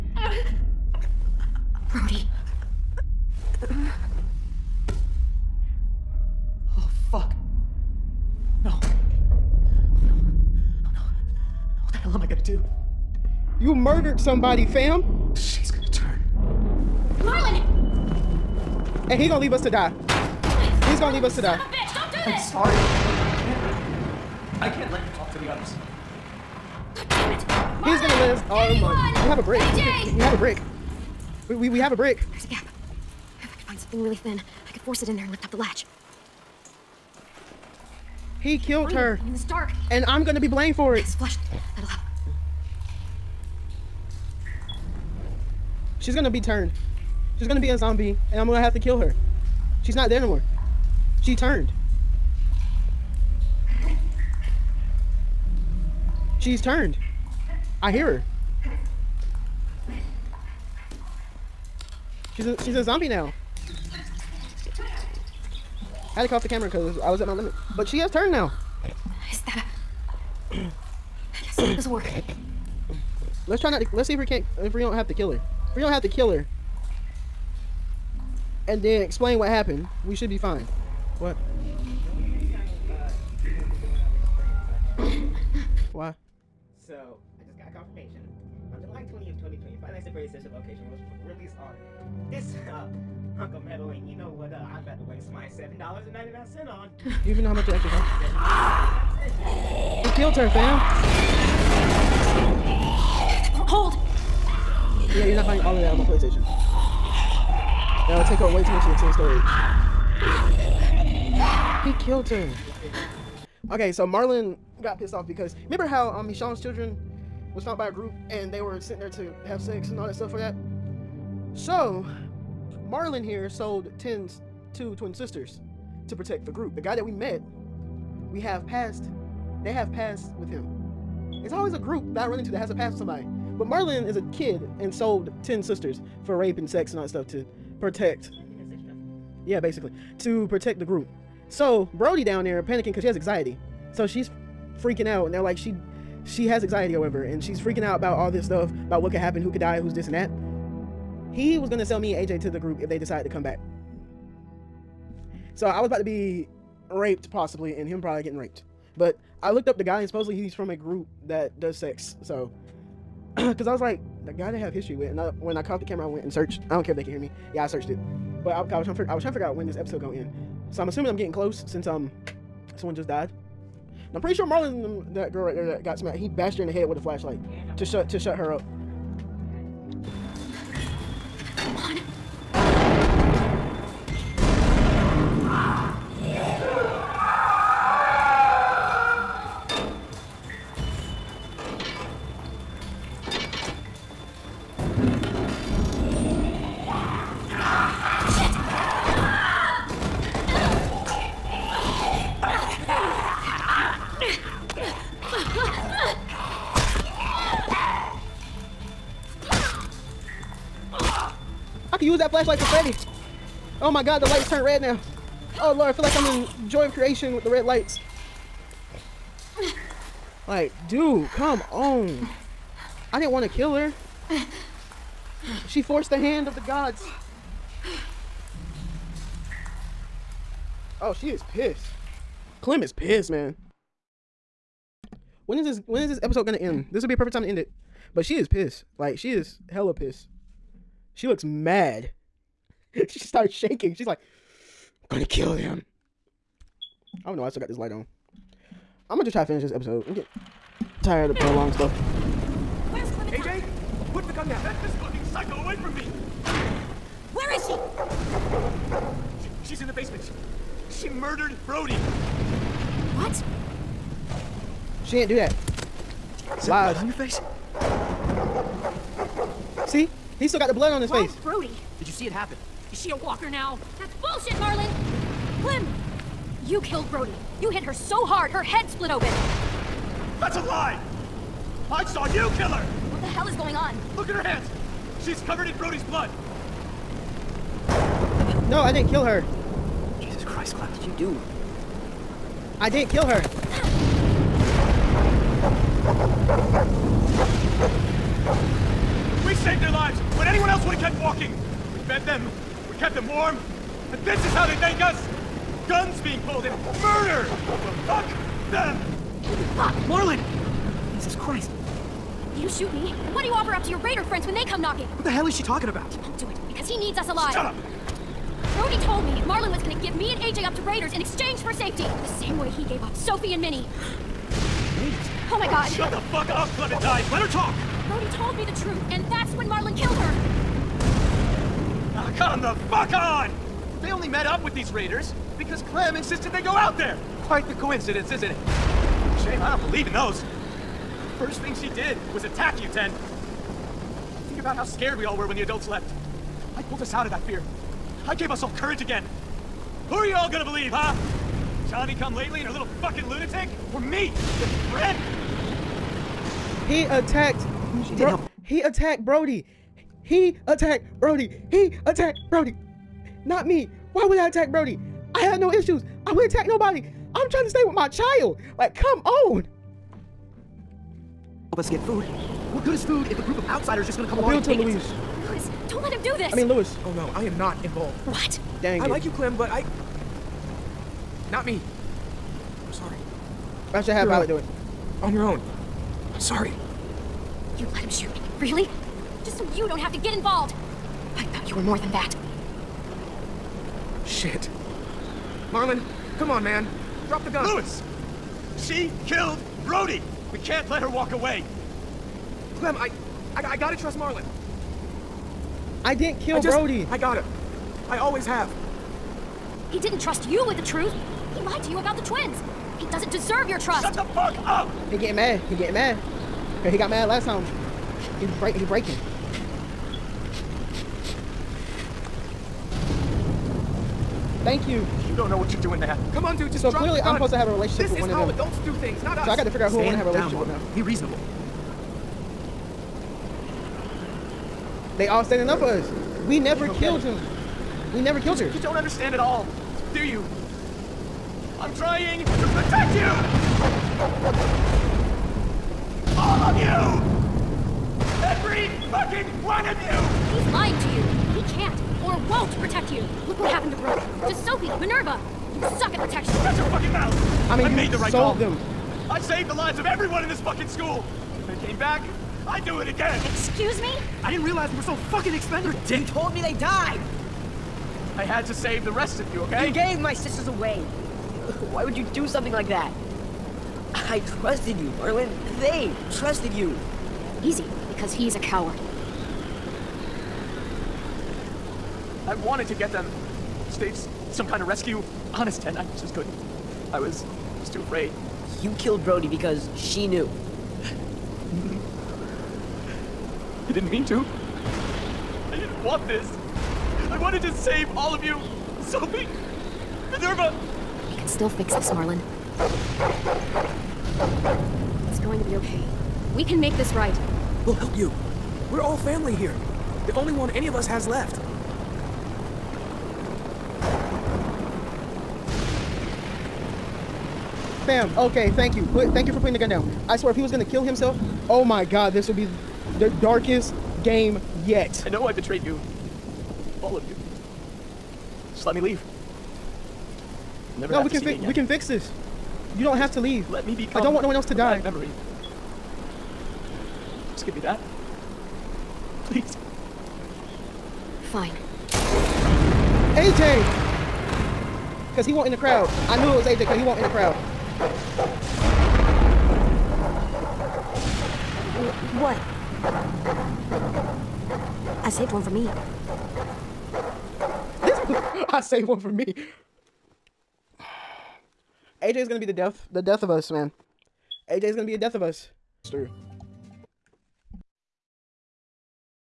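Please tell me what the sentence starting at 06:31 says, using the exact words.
I thought you were more than that.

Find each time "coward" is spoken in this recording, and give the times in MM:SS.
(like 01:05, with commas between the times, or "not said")
07:58.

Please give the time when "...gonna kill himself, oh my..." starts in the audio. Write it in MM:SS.
08:40.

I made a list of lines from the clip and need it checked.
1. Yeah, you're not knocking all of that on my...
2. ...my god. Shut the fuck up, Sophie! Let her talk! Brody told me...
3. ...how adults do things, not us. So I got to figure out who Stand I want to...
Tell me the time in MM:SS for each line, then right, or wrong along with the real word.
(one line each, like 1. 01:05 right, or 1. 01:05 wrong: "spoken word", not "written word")
1. 01:45 wrong: "buying", not "knocking"
2. 05:25 wrong: "Clementine", not "Sophie"
3. 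07:08 right.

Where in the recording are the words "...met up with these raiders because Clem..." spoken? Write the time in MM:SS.
05:34.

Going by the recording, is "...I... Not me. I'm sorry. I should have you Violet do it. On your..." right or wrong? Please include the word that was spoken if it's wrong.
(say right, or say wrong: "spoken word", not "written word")
right.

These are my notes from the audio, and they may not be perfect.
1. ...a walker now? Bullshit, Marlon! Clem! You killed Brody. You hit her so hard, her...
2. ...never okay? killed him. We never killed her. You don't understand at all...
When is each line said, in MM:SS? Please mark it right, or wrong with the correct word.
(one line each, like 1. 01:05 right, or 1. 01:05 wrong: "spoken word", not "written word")
1. 04:33 right
2. 07:16 right.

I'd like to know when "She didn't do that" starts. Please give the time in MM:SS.
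04:25.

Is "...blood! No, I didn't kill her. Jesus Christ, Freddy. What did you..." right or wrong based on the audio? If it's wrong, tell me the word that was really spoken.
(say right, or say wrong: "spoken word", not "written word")
wrong: "Clem", not "Freddy".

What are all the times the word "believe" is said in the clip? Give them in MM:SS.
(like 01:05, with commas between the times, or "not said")
05:39, 05:50.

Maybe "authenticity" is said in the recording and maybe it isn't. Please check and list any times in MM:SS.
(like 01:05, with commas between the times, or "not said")
not said.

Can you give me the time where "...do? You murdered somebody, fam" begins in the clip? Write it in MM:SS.
00:12.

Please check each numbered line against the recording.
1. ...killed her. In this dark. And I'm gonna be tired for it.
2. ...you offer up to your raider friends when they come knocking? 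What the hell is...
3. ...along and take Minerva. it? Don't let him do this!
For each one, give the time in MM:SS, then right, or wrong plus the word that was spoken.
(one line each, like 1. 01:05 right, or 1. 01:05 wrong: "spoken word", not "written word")
1. 00:38 wrong: "blamed", not "tired"
2. 05:13 right
3. 06:14 wrong: "Louis", not "Minerva".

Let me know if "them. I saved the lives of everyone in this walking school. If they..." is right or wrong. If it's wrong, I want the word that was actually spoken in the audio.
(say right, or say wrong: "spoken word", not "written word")
wrong: "fucking", not "walking".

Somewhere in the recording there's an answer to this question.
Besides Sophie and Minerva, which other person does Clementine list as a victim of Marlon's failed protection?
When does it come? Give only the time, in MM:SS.
07:33.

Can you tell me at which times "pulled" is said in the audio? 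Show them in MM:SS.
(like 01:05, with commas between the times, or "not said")
05:06, 05:46.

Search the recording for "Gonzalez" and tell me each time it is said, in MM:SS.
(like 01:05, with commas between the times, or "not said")
not said.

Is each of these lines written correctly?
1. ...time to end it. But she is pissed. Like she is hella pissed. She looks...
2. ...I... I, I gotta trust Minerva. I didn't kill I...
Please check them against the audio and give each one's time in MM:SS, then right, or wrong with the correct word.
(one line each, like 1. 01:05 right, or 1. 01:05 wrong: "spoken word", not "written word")
1. 03:57 right
2. 06:42 wrong: "Marlon", not "Minerva".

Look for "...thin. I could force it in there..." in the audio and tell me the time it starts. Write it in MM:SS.
00:34.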